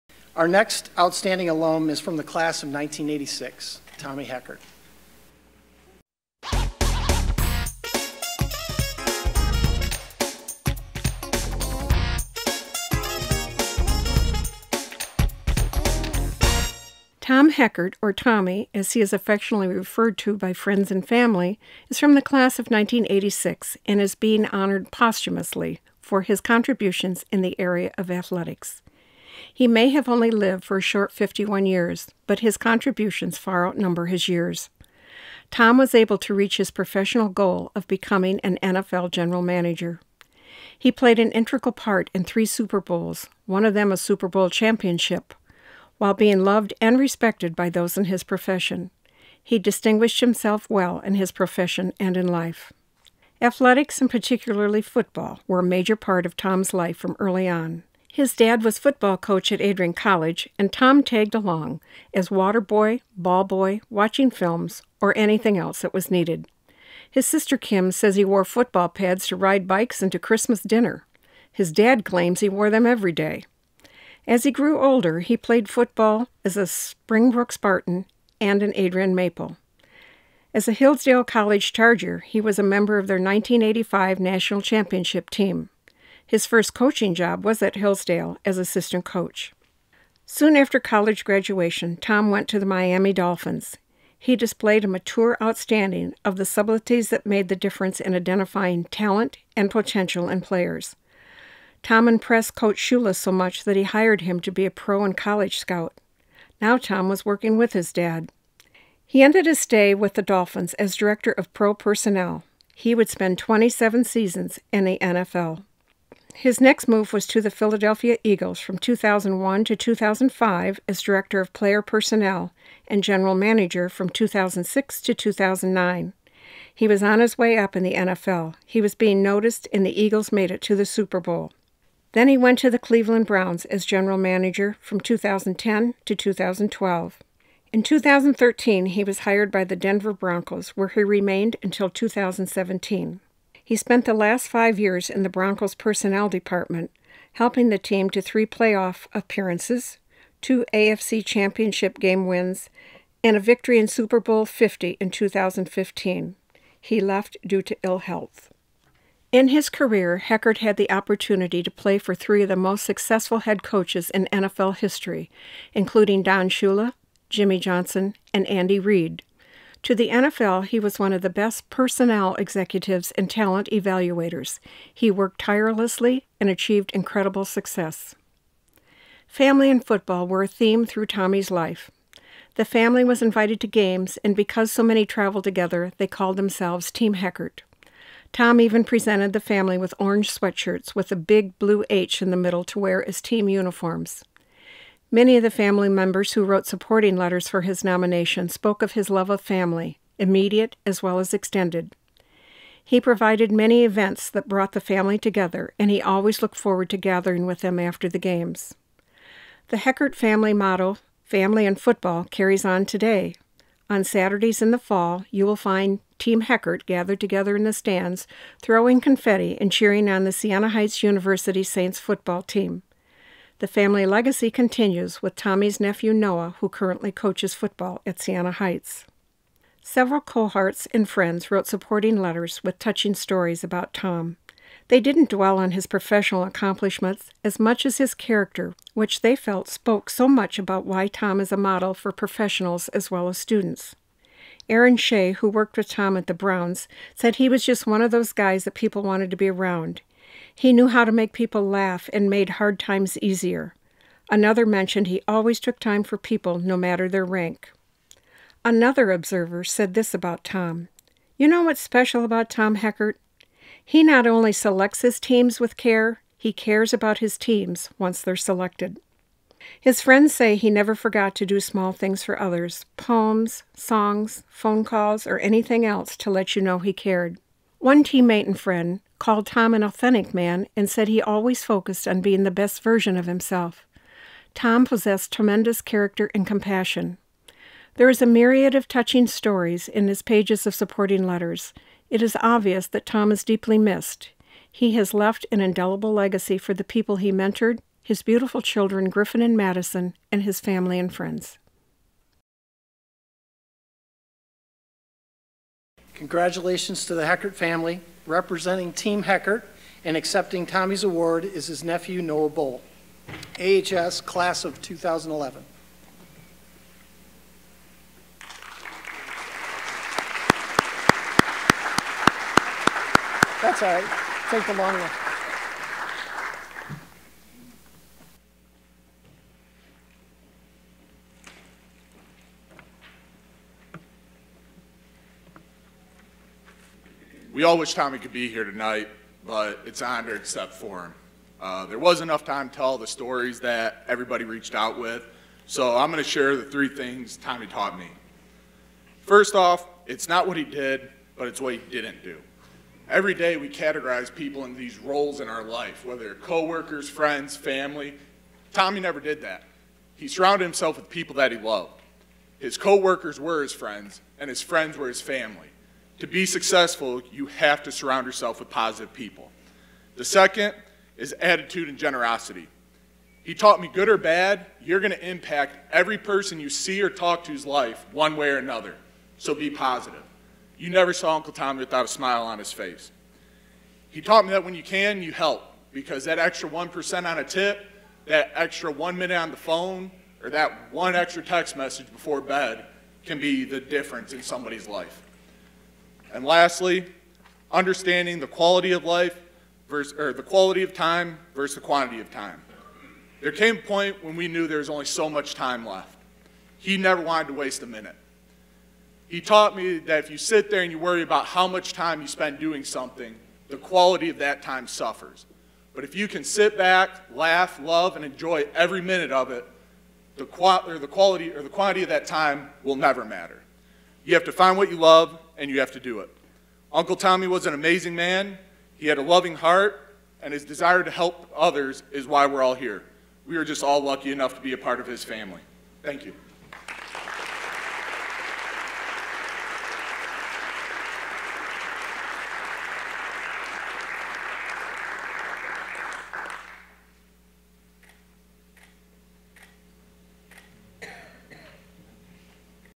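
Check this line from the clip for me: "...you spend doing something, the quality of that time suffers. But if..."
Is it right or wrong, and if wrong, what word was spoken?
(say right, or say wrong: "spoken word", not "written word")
right.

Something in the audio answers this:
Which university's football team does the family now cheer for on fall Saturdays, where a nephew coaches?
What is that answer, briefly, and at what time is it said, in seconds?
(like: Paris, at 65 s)
Siena Heights University, at 220 s.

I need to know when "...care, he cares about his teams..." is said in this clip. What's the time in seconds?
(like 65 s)
265 s.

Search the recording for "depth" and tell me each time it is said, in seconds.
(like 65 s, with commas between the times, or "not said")
not said.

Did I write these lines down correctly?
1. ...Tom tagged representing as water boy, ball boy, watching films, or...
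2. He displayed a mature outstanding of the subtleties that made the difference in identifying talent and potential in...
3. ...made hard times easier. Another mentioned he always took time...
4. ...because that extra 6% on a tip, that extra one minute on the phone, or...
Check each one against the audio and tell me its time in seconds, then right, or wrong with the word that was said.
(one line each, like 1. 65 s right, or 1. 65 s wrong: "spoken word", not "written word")
1. 60 s wrong: "along", not "representing"
2. 94 s right
3. 252 s right
4. 385 s wrong: "1", not "6".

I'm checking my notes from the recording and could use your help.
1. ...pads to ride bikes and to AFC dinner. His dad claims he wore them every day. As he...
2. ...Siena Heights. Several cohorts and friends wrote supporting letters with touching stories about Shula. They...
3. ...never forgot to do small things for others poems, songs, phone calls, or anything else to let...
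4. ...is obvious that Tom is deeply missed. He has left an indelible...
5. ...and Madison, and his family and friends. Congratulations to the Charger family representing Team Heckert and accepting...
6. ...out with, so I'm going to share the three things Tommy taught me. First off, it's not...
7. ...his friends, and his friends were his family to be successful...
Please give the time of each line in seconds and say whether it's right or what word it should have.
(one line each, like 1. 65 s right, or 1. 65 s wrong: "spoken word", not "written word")
1. 68 s wrong: "Christmas", not "AFC"
2. 228 s wrong: "Tom", not "Shula"
3. 270 s right
4. 292 s right
5. 299 s wrong: "Heckert", not "Charger"
6. 344 s right
7. 363 s right.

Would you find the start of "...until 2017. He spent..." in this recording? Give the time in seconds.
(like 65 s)
141 s.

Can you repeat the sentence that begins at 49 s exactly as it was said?
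He distinguished himself well in his profession and in life.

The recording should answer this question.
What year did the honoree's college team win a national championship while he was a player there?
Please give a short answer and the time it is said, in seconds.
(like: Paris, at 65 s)
1985, at 83 s.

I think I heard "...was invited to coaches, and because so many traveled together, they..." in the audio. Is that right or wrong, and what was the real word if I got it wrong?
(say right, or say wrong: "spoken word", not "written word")
wrong: "games", not "coaches".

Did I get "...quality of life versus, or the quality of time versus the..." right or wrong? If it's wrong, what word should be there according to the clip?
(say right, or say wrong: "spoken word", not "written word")
right.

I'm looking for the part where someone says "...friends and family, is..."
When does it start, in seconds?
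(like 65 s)
20 s.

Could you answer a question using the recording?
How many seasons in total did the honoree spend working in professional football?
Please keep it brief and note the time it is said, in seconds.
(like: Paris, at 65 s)
27, at 113 s.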